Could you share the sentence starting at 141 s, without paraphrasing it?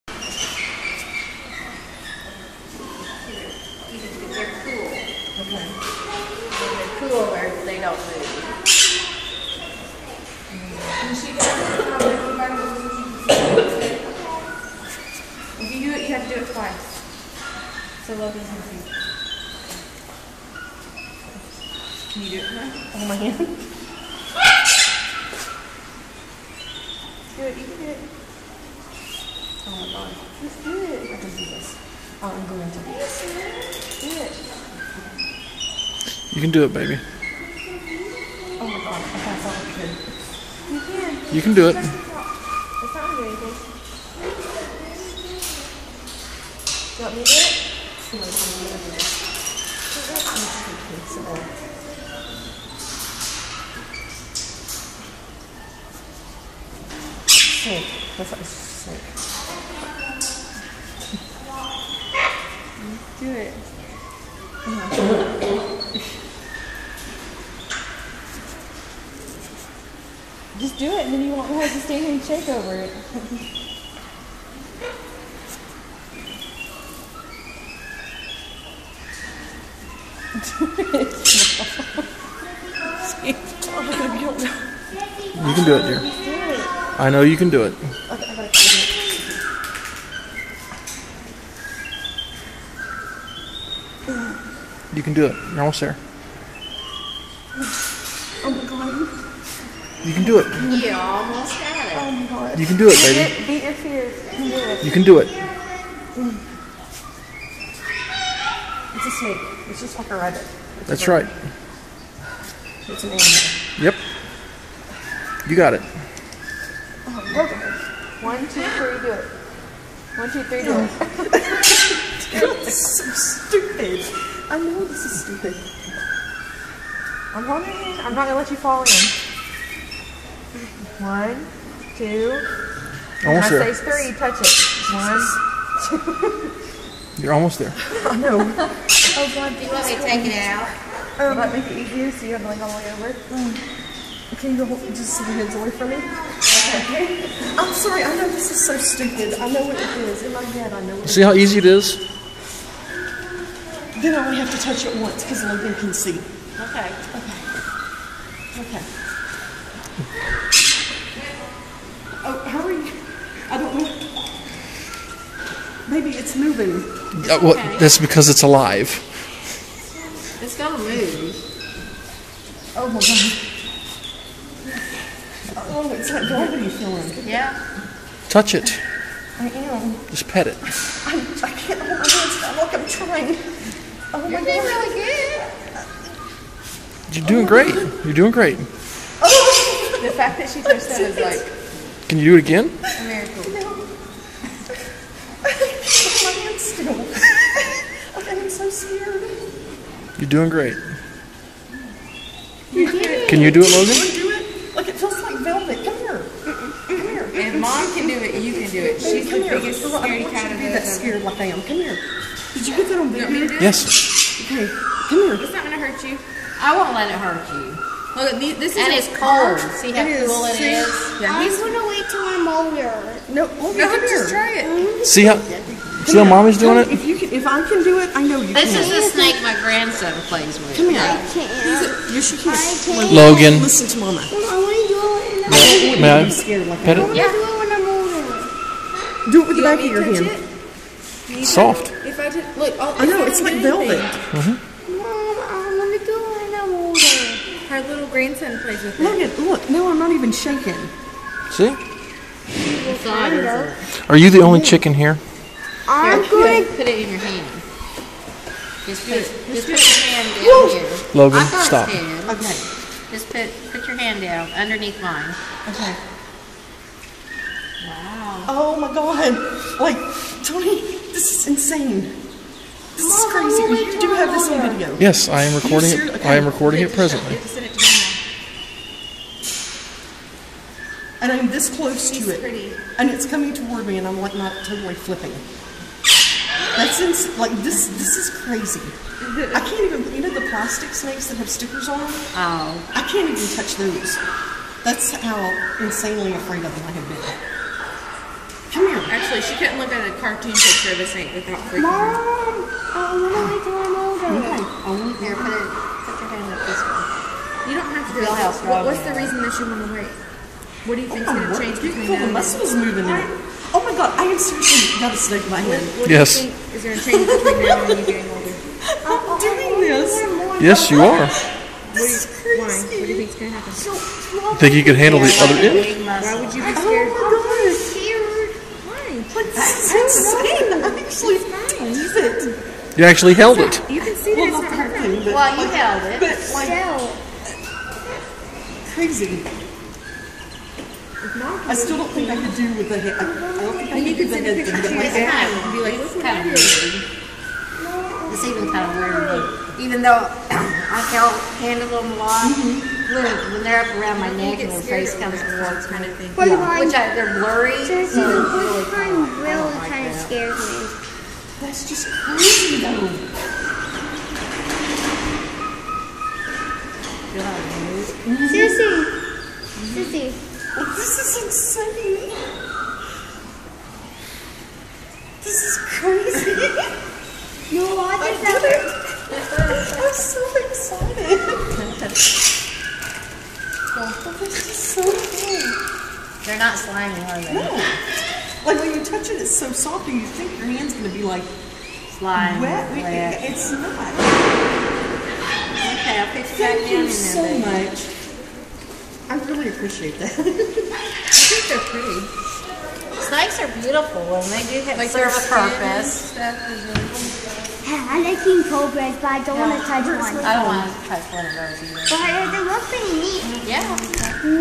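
Um, that make it easier so you have to like all the way over.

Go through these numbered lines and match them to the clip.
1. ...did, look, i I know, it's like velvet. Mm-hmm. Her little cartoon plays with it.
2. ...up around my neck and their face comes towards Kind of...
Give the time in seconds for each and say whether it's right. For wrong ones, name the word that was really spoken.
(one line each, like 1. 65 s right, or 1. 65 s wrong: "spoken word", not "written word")
1. 242 s wrong: "grandson", not "cartoon"
2. 353 s right.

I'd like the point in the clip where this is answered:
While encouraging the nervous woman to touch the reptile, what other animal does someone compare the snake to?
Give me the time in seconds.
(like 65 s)
109 s.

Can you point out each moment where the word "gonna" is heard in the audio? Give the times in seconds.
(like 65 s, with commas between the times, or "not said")
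128 s, 215 s, 221 s.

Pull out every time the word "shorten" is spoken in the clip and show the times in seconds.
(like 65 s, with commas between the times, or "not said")
not said.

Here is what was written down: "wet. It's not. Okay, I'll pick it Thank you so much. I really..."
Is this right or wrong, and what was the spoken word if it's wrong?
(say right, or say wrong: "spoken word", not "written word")
right.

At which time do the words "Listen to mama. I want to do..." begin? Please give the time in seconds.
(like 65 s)
233 s.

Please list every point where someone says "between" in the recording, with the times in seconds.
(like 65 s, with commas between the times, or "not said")
311 s, 317 s.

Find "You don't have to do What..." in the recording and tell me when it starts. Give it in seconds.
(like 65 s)
307 s.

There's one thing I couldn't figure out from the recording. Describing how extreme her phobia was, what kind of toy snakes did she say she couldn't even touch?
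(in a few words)
plastic snakes.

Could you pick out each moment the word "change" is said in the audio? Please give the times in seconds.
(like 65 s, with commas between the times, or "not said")
311 s, 316 s.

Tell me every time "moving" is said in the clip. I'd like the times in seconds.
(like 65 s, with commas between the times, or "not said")
166 s, 312 s.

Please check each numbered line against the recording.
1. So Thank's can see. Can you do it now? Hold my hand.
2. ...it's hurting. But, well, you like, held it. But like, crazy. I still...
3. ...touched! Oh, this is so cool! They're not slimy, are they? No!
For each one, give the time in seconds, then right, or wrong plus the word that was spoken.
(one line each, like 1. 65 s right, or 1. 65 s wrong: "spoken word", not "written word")
1. 18 s wrong: "Logan", not "Thank"
2. 334 s right
3. 380 s wrong: "excited", not "touched".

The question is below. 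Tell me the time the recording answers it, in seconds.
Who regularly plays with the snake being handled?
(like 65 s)
228 s.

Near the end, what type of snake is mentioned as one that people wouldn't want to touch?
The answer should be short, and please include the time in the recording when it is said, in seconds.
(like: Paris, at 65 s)
cobras, at 407 s.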